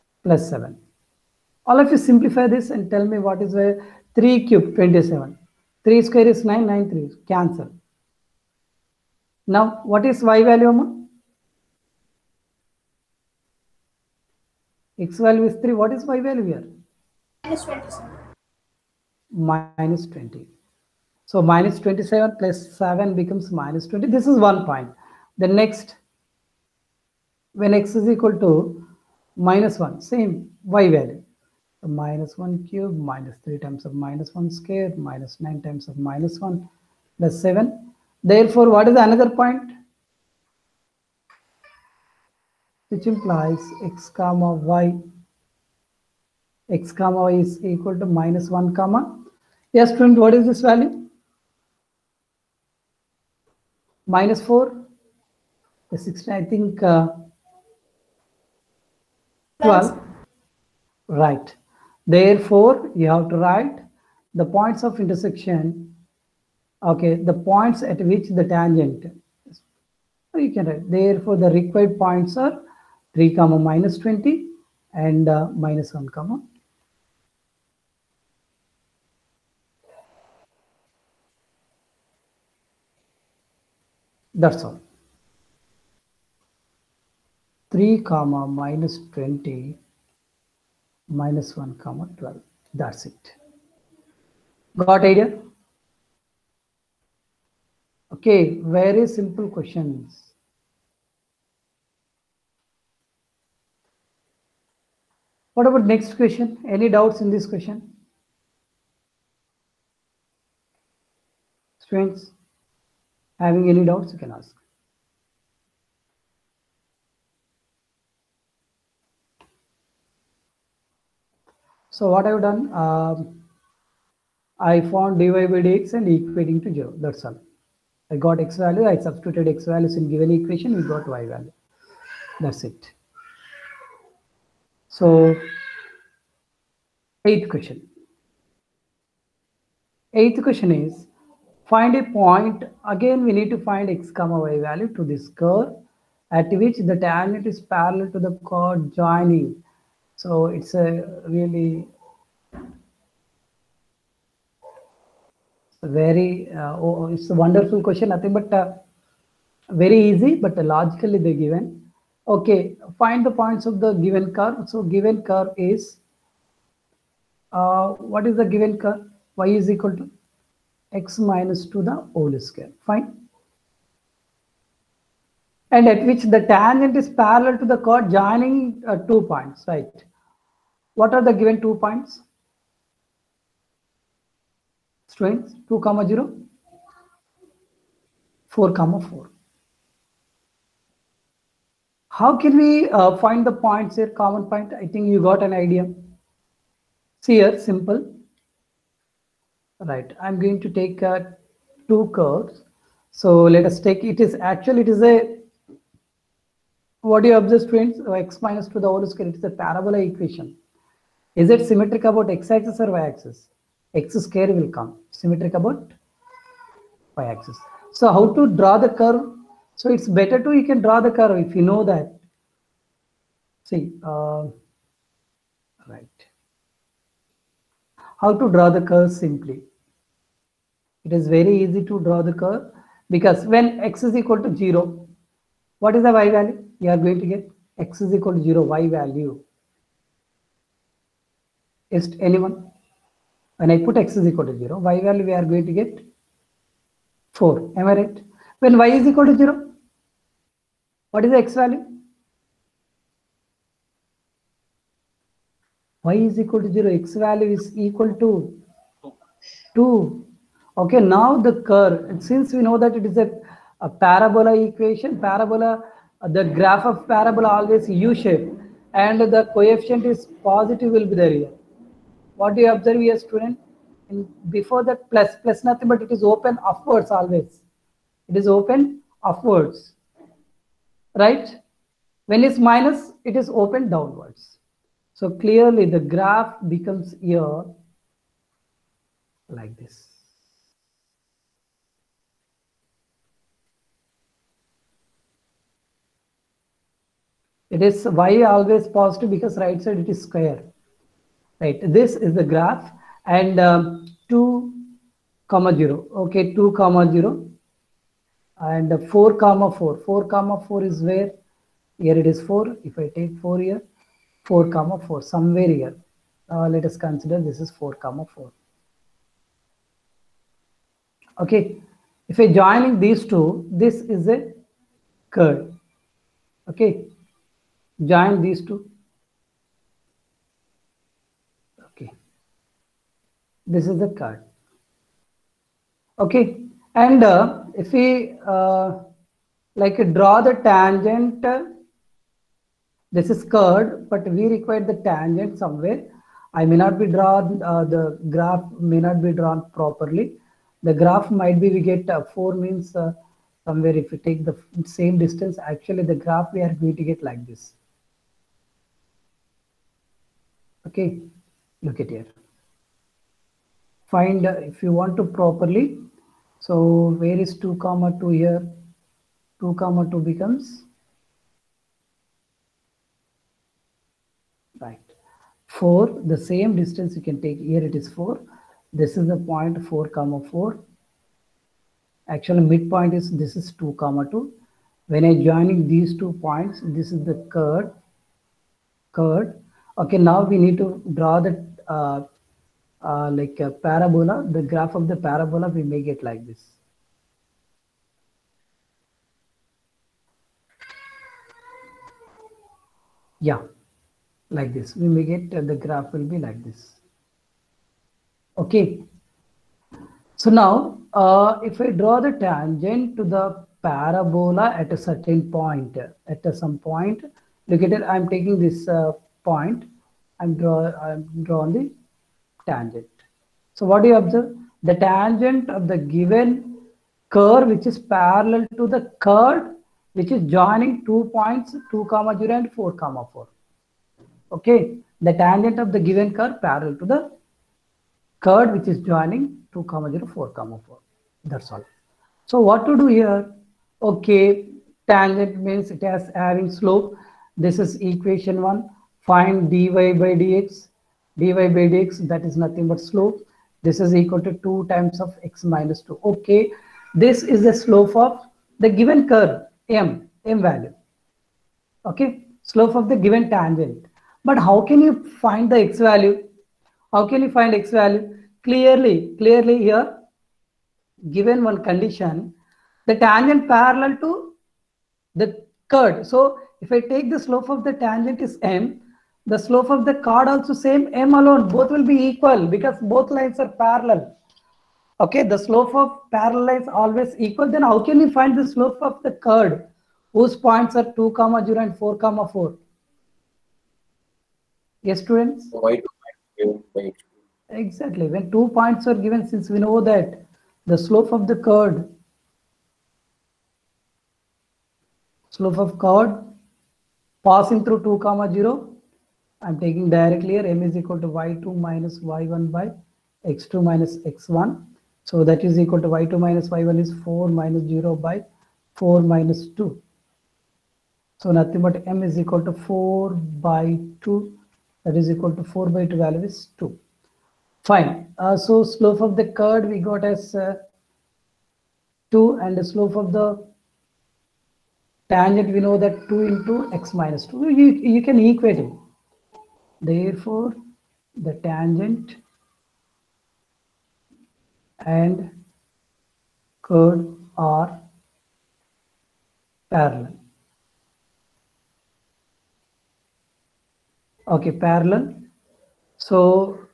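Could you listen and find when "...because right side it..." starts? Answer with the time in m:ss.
4:59.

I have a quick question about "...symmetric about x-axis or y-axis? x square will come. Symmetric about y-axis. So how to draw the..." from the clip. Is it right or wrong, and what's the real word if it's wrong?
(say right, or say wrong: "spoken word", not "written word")
right.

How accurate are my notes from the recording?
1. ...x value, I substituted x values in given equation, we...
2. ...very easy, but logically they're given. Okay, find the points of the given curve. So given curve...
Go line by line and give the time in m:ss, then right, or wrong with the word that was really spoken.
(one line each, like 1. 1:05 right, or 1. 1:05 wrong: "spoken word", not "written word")
1. 2:08 right
2. 2:39 right.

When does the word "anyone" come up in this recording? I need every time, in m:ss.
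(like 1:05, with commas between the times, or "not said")
4:02.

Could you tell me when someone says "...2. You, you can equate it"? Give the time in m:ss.
8:57.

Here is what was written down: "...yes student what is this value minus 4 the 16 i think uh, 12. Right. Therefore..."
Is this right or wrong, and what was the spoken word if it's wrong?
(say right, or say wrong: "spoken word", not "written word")
right.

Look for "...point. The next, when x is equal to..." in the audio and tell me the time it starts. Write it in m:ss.
0:24.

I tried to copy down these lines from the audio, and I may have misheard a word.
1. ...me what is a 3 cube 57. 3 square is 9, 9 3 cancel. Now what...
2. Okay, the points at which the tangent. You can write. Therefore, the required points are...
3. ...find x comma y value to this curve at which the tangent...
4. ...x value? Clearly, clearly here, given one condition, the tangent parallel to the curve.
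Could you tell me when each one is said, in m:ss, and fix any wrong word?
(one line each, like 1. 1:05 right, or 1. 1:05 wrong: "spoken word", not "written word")
1. 0:03 wrong: "27", not "57"
2. 1:06 right
3. 2:23 right
4. 7:47 right.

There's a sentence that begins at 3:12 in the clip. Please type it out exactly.
How can we uh, find the points here, common point?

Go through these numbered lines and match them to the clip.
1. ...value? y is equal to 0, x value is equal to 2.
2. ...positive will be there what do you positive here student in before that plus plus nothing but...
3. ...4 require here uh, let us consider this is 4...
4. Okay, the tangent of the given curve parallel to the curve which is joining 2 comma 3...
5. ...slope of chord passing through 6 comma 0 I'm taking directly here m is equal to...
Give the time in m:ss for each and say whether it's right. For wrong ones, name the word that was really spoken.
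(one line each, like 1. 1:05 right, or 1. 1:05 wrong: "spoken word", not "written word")
1. 4:11 right
2. 4:30 wrong: "observe", not "positive"
3. 5:14 wrong: "somewhere", not "require"
4. 7:14 wrong: "0", not "3"
5. 8:25 wrong: "2", not "6".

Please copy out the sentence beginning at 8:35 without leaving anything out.
So that is equal to y2 minus y1 is 4 minus 0 by 4 minus 2.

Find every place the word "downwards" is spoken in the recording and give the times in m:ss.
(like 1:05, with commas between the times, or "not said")
4:43.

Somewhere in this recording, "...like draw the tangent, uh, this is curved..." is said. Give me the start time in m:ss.
5:39.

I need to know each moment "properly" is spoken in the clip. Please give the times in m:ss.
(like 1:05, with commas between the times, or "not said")
5:49, 6:05.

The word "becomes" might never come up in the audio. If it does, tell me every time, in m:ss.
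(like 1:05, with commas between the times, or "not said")
0:23, 4:46, 6:10.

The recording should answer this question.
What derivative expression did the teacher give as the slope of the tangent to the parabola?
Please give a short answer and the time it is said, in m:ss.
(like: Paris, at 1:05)
2(x - 2), at 7:34.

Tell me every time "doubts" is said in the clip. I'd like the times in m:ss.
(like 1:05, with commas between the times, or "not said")
1:46, 1:53.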